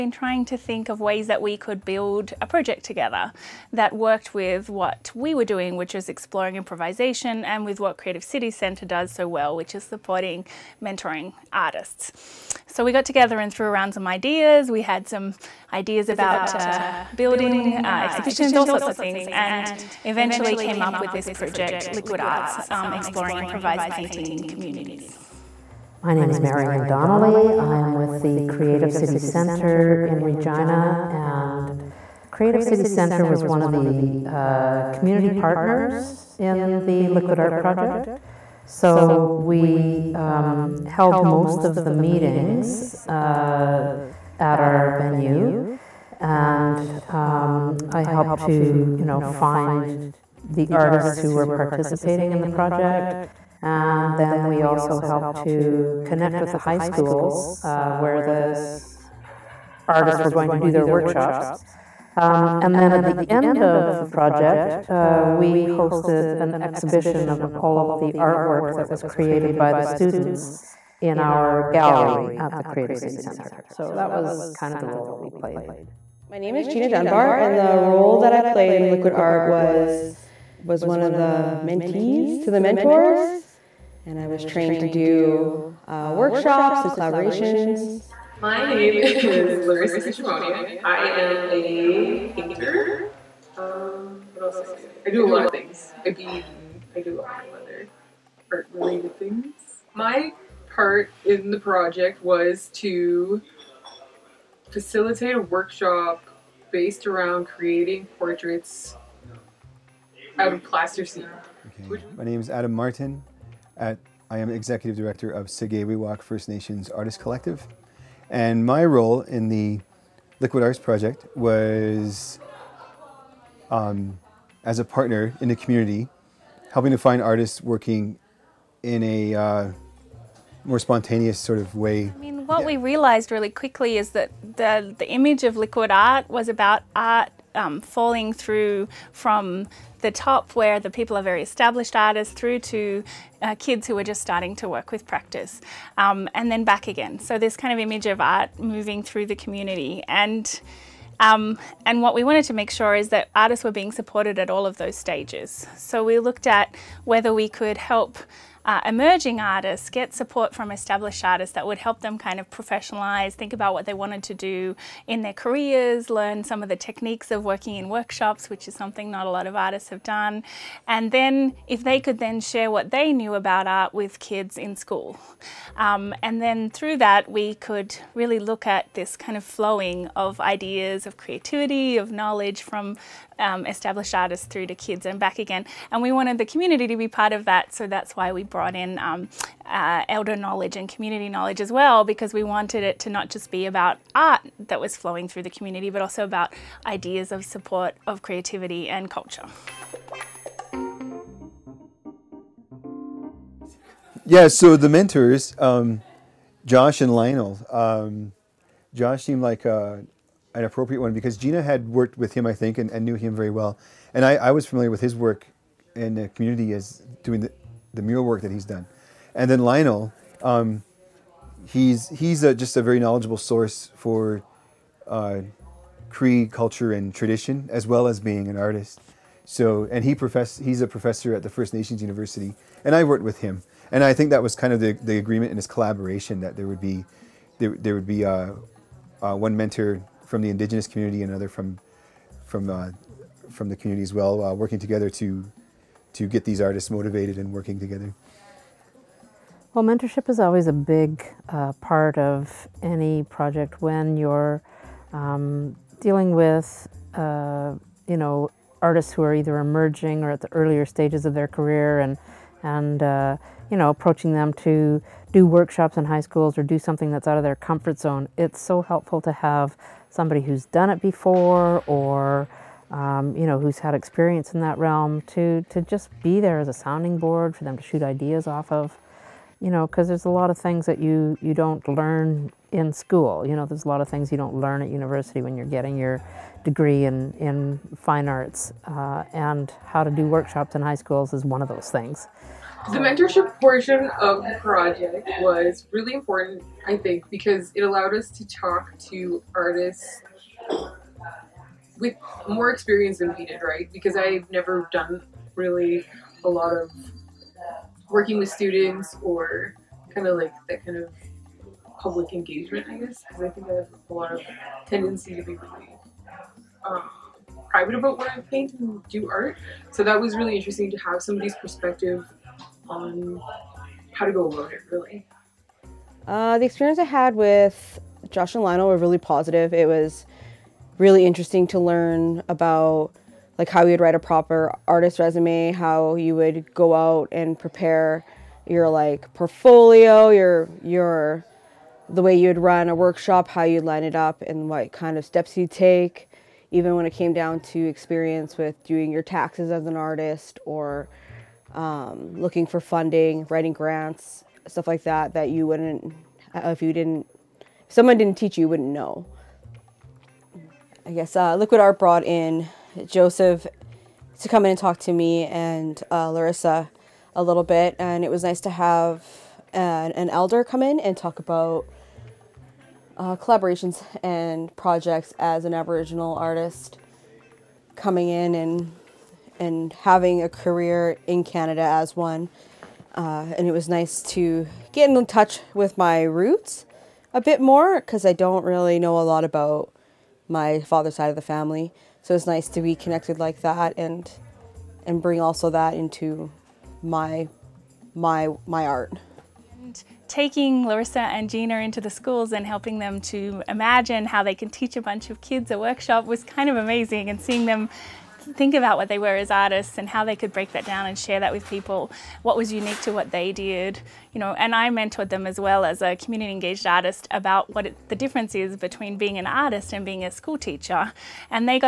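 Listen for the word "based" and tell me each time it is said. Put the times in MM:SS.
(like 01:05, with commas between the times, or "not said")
01:46.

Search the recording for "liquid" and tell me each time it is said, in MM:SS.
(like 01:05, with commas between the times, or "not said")
00:21, 00:37, 01:18, 02:00, 02:15, 06:01.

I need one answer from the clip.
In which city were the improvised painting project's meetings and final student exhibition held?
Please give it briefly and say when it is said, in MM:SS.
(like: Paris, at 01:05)
Regina, at 00:30.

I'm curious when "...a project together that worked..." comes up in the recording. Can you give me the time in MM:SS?
00:02.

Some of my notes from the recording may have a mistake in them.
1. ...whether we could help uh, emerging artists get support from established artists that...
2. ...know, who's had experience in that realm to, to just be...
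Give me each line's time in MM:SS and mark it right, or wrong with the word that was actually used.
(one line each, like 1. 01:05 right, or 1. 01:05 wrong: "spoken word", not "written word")
1. 02:37 right
2. 04:33 right.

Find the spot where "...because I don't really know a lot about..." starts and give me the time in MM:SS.
06:28.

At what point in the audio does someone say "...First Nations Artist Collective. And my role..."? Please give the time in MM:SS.
01:56.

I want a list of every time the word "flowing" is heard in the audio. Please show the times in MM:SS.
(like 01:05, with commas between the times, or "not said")
02:59, 03:14.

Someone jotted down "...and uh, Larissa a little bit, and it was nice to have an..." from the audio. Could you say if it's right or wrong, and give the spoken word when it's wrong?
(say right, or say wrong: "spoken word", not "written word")
right.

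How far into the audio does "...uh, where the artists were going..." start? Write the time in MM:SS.
00:57.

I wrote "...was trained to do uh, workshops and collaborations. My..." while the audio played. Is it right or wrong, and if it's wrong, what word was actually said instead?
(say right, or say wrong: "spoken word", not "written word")
right.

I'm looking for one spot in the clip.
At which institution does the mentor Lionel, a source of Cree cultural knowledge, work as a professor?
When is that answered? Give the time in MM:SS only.
03:51.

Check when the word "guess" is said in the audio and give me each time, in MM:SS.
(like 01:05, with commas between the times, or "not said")
05:12, 06:01.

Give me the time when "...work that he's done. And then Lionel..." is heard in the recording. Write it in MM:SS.
03:38.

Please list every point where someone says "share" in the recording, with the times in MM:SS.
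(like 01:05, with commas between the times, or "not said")
02:52, 06:51.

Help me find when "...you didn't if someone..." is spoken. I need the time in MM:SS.
05:56.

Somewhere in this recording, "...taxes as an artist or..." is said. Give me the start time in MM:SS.
05:49.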